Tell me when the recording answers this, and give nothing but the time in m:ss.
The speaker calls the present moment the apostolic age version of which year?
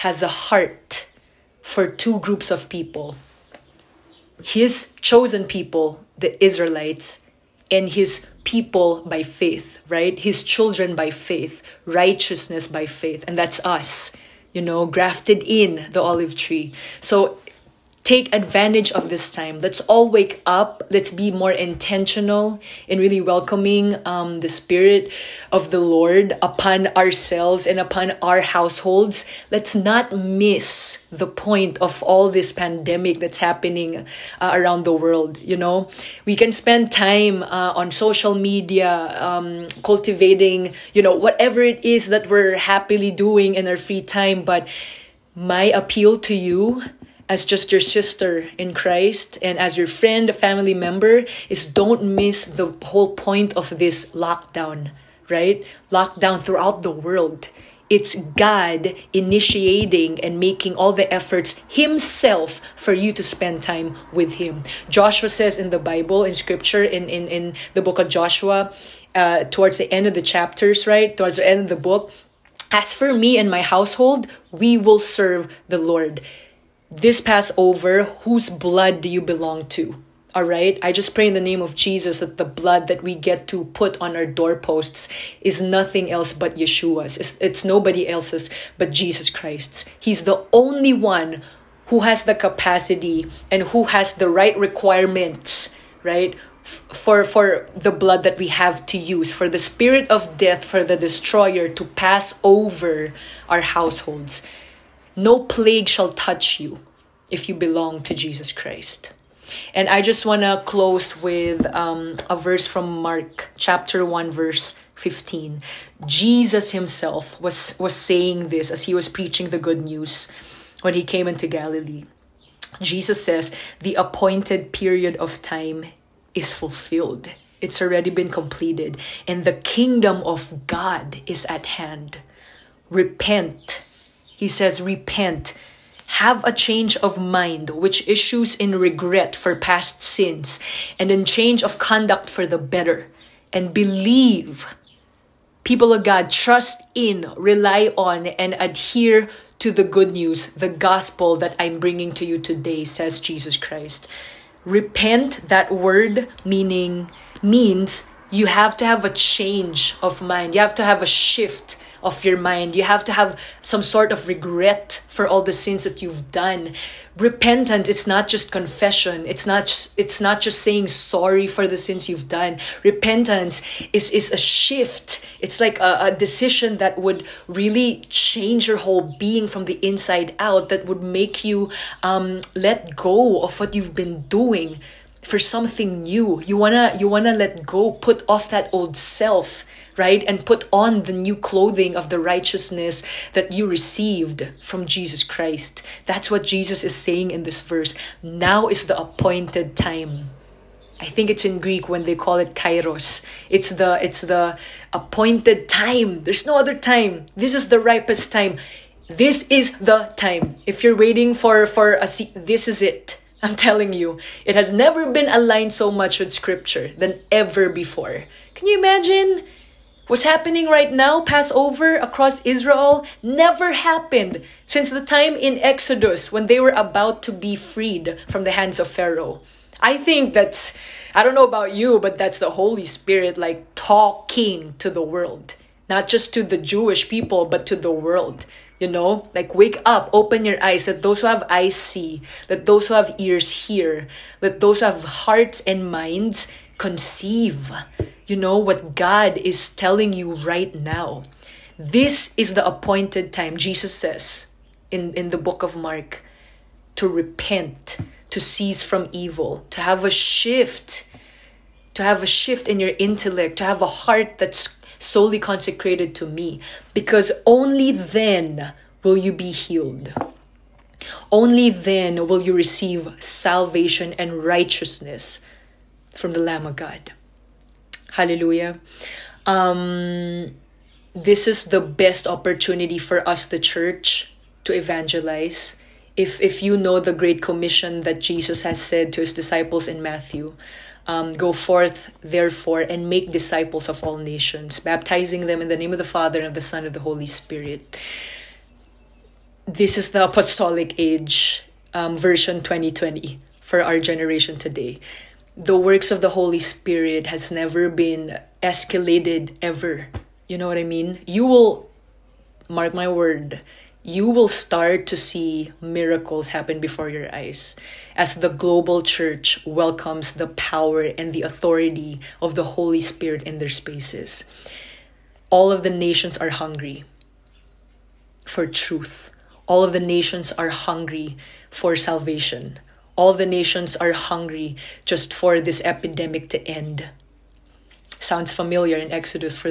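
5:02.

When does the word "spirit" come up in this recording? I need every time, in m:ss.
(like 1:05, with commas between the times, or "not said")
0:24, 1:39, 3:52, 4:57, 5:06, 5:22.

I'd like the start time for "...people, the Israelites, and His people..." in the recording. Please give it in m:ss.
0:05.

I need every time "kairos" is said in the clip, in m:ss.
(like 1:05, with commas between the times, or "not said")
3:22.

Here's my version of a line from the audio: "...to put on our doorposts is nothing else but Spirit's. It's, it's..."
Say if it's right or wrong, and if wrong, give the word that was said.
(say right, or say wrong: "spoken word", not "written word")
wrong: "Yeshua", not "Spirit".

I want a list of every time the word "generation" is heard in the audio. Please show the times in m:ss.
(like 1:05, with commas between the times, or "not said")
5:03.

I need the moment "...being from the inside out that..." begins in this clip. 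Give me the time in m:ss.
2:59.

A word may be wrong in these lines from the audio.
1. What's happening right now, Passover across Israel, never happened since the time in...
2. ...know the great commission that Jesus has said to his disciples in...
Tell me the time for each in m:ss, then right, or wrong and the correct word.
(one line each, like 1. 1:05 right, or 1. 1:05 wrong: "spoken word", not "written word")
1. 3:40 right
2. 4:46 right.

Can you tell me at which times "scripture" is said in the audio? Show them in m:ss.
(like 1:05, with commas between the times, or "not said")
1:06, 3:36.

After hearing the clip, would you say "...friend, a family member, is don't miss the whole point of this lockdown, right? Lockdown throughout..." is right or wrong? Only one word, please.
right.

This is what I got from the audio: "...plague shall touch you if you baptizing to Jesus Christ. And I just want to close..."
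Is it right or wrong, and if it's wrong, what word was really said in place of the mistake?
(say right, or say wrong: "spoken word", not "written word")
wrong: "belong", not "baptizing".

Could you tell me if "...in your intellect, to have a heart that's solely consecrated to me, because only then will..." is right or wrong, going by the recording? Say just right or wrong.
right.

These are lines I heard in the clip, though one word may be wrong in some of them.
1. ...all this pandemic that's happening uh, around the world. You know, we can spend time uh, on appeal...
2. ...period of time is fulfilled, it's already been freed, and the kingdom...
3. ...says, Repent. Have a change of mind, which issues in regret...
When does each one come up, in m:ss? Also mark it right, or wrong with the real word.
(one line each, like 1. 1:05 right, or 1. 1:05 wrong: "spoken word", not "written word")
1. 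0:32 wrong: "social", not "appeal"
2. 2:04 wrong: "completed", not "freed"
3. 2:14 right.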